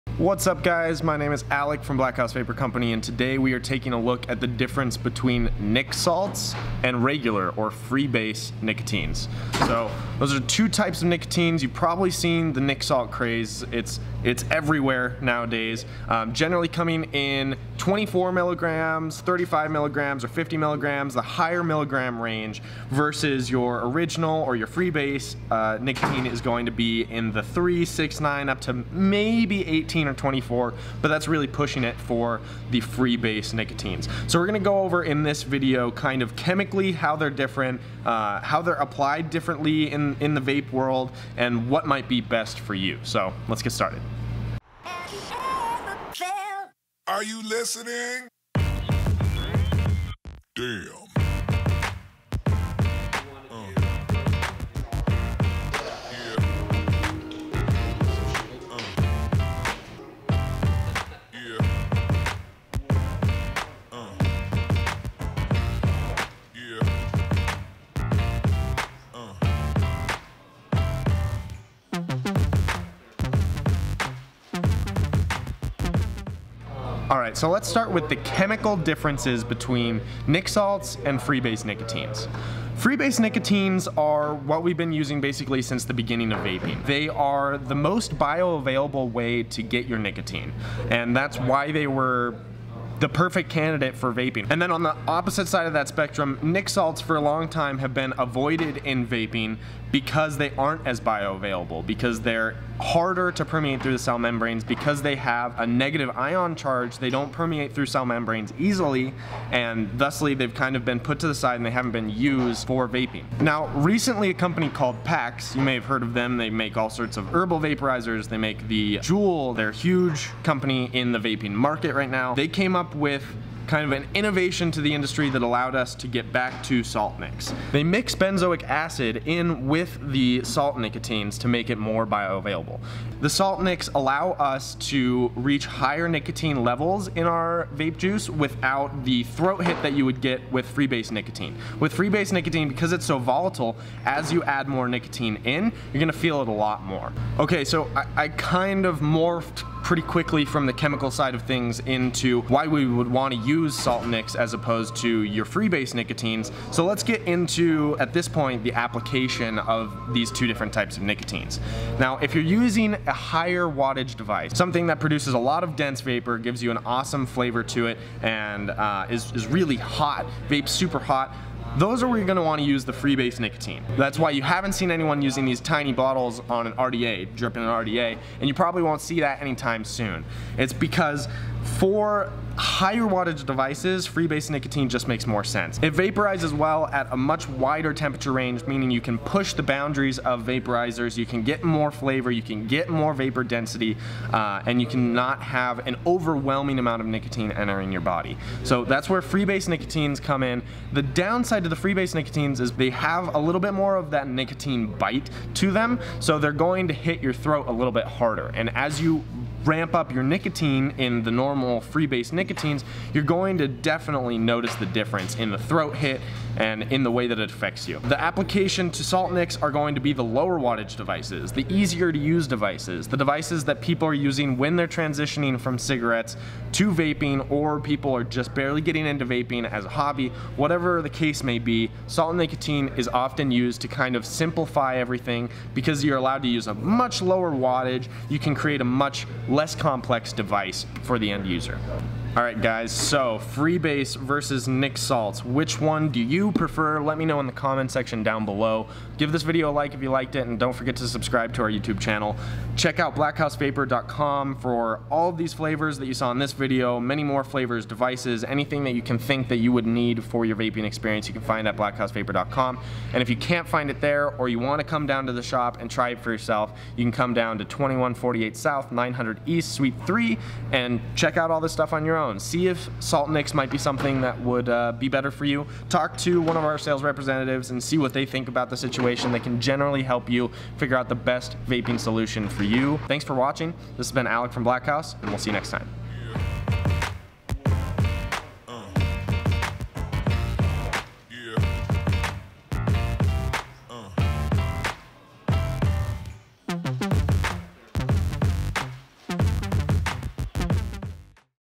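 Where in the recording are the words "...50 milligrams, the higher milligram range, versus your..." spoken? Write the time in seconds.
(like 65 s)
20 s.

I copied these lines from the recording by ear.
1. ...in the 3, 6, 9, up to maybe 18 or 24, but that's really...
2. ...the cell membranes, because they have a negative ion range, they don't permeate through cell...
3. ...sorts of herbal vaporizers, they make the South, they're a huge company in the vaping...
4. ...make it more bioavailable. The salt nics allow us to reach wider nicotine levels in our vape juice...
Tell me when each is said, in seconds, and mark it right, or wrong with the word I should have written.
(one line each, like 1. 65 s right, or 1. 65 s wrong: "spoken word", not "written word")
1. 27 s right
2. 103 s wrong: "charge", not "range"
3. 116 s wrong: "Juul", not "South"
4. 131 s wrong: "higher", not "wider".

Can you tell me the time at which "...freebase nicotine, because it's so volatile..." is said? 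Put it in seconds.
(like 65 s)
141 s.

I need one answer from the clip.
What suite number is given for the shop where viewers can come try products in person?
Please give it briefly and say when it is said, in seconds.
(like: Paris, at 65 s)
3, at 269 s.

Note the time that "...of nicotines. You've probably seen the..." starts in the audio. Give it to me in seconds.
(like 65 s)
11 s.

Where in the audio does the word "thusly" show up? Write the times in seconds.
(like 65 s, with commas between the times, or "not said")
109 s.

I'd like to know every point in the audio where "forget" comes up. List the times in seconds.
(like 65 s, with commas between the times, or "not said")
250 s.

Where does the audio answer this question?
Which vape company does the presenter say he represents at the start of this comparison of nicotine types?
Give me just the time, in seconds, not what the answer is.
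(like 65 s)
1 s.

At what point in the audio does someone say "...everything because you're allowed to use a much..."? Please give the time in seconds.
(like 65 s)
234 s.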